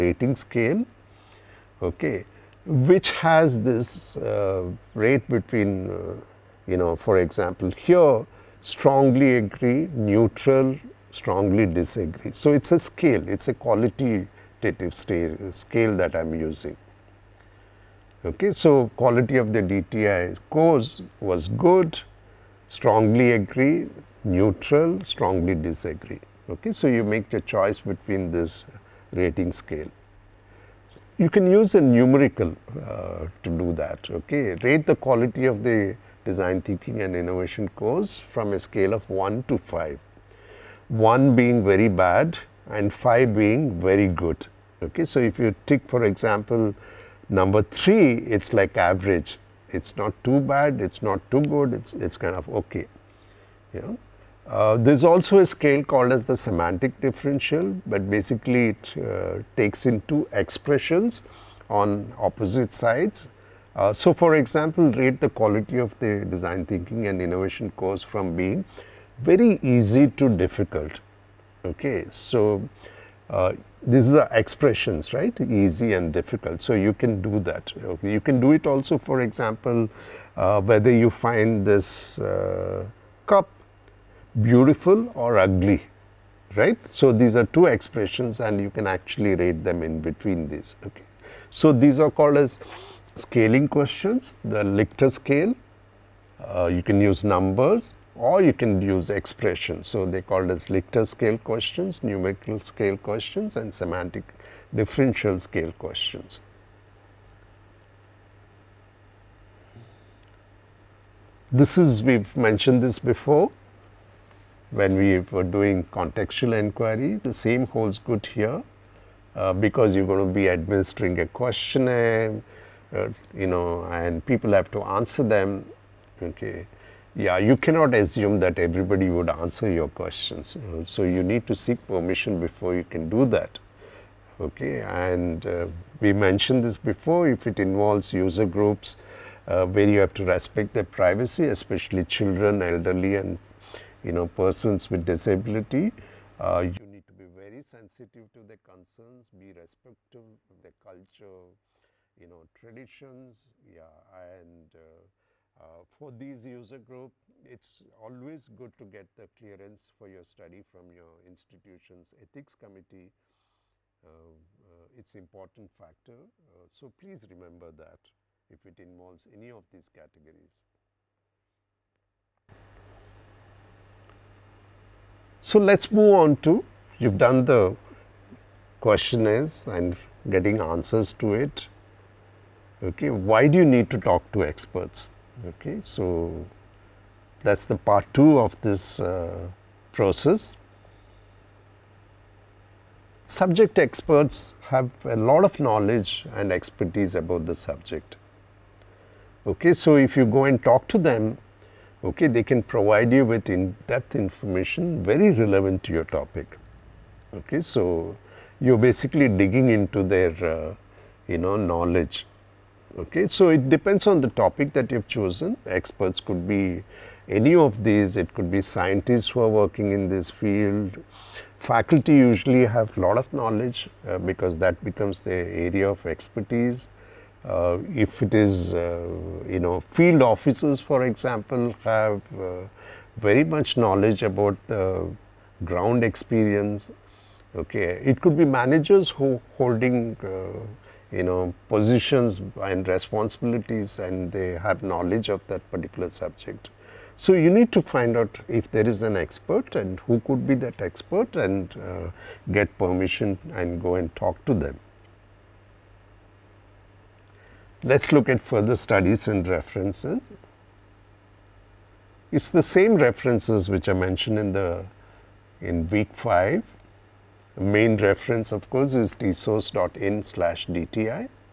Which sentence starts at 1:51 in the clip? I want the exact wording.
This is, we've mentioned this before, when we were doing contextual inquiry.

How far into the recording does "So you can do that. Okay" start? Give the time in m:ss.
1:16.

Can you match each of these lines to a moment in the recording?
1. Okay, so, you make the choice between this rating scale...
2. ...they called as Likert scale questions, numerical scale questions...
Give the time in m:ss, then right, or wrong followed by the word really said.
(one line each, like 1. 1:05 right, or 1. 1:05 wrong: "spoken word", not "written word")
1. 0:26 right
2. 1:40 right.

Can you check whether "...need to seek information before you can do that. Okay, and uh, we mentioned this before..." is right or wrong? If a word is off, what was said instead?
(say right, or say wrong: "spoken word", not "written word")
wrong: "permission", not "information".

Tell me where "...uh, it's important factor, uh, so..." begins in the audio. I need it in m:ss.
2:44.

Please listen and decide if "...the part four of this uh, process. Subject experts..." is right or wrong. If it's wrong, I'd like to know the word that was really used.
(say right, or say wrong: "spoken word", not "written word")
wrong: "two", not "four".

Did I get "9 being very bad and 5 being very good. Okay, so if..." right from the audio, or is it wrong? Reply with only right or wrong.
wrong.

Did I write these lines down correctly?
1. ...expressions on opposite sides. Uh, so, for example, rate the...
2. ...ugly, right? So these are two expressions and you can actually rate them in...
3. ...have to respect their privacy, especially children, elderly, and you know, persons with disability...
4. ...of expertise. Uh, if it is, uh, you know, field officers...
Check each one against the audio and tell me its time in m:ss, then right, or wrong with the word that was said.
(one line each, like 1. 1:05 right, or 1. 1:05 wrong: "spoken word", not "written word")
1. 1:00 right
2. 1:25 right
3. 2:19 right
4. 3:45 right.